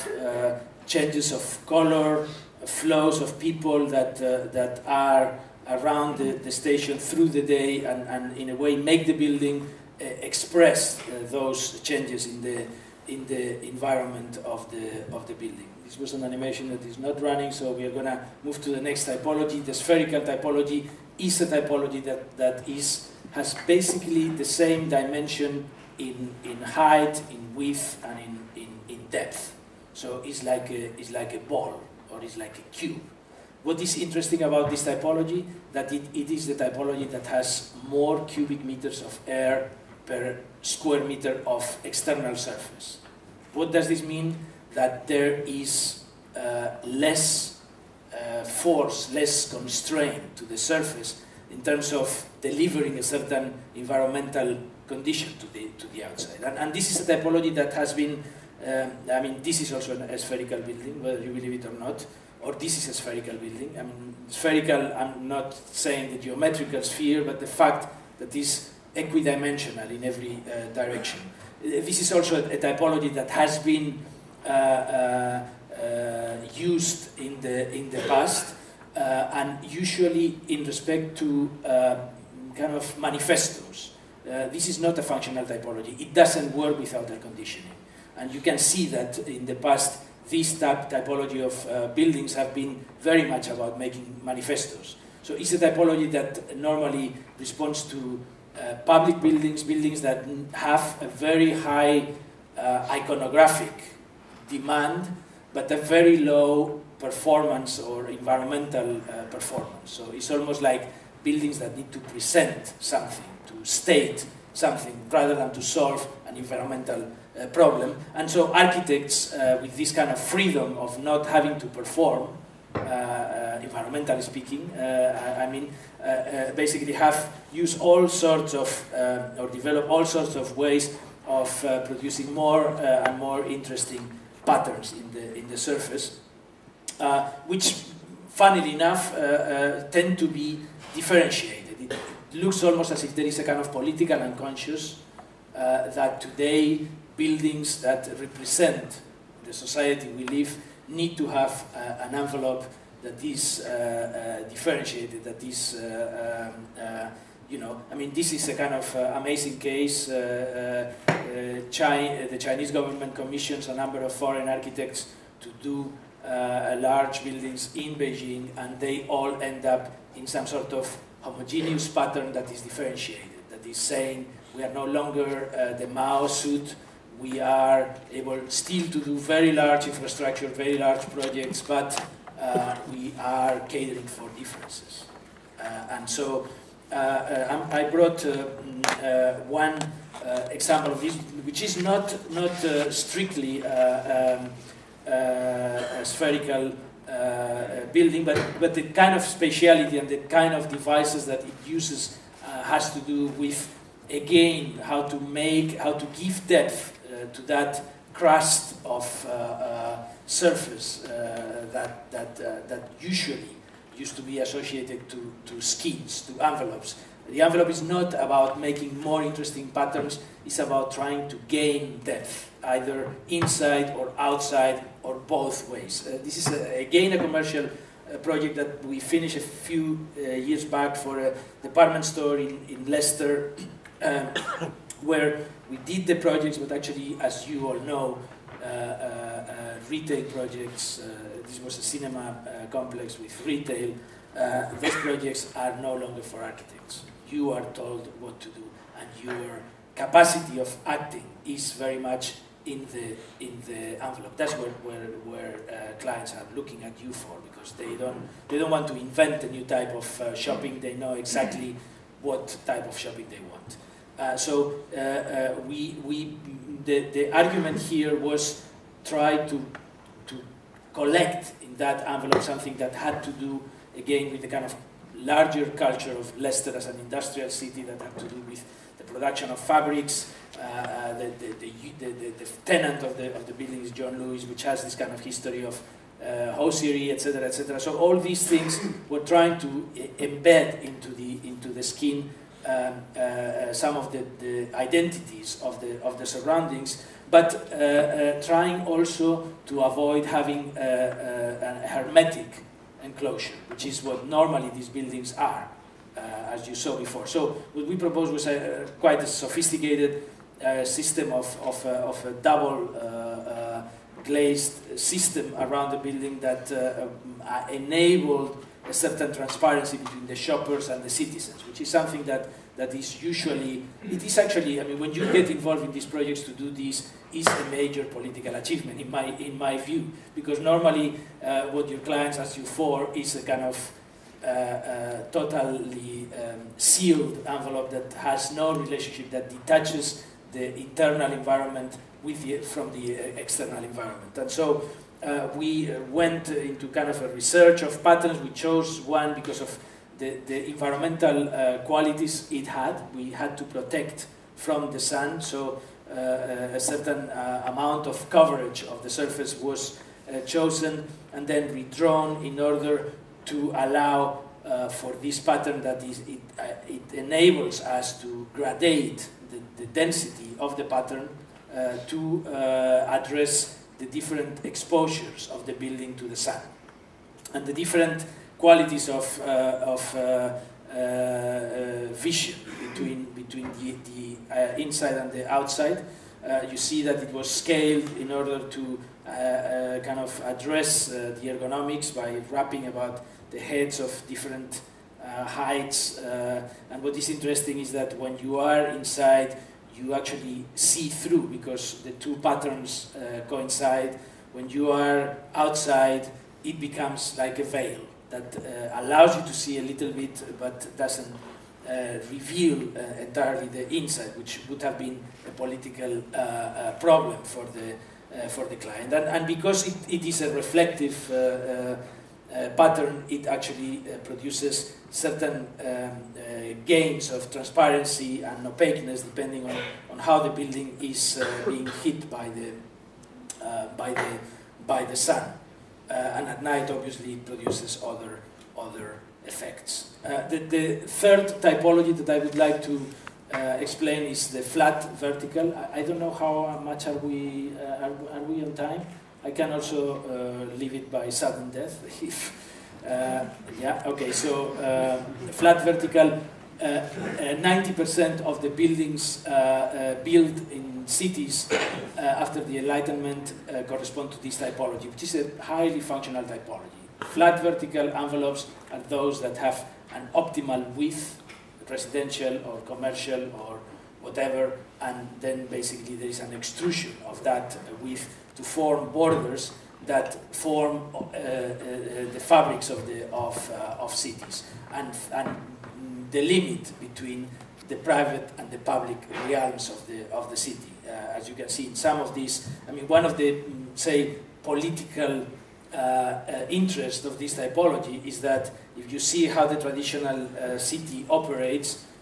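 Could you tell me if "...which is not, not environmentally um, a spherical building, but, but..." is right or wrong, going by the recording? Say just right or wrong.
wrong.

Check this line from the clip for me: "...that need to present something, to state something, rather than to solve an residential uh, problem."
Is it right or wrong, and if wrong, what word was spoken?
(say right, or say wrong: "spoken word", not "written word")
wrong: "environmental", not "residential".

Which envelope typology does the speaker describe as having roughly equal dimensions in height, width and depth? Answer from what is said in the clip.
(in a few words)
Spherical typology.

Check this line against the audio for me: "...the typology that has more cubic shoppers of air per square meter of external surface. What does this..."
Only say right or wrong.
wrong.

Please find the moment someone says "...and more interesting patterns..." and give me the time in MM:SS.
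02:12.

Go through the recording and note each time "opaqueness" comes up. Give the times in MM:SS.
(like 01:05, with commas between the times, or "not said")
07:08.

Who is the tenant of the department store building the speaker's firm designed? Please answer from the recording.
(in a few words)
John Lewis.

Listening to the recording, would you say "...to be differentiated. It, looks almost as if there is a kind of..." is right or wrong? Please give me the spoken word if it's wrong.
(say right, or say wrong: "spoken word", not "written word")
right.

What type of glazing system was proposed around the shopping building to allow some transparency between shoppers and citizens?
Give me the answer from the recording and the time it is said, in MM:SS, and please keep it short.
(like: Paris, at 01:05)
Double glazed system, at 05:12.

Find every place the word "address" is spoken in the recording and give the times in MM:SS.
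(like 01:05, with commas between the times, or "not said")
06:13, 06:30.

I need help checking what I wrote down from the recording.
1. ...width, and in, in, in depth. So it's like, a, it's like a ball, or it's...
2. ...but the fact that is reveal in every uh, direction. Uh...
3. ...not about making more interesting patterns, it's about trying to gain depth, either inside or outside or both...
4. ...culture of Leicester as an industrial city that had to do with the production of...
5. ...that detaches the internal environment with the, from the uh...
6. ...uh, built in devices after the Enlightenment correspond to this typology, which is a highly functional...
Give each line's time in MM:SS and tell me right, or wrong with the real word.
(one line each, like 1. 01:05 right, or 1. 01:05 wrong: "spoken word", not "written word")
1. 00:27 right
2. 01:07 wrong: "equidimensional", not "reveal"
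3. 03:37 right
4. 04:35 right
5. 05:39 right
6. 07:39 wrong: "cities", not "devices".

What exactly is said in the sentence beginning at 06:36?
and what is interesting is that when you are inside, you actually see through because the two patterns uh, coincide.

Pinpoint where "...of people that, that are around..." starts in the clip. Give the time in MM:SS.
00:03.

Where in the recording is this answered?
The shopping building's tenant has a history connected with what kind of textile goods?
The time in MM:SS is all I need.
04:46.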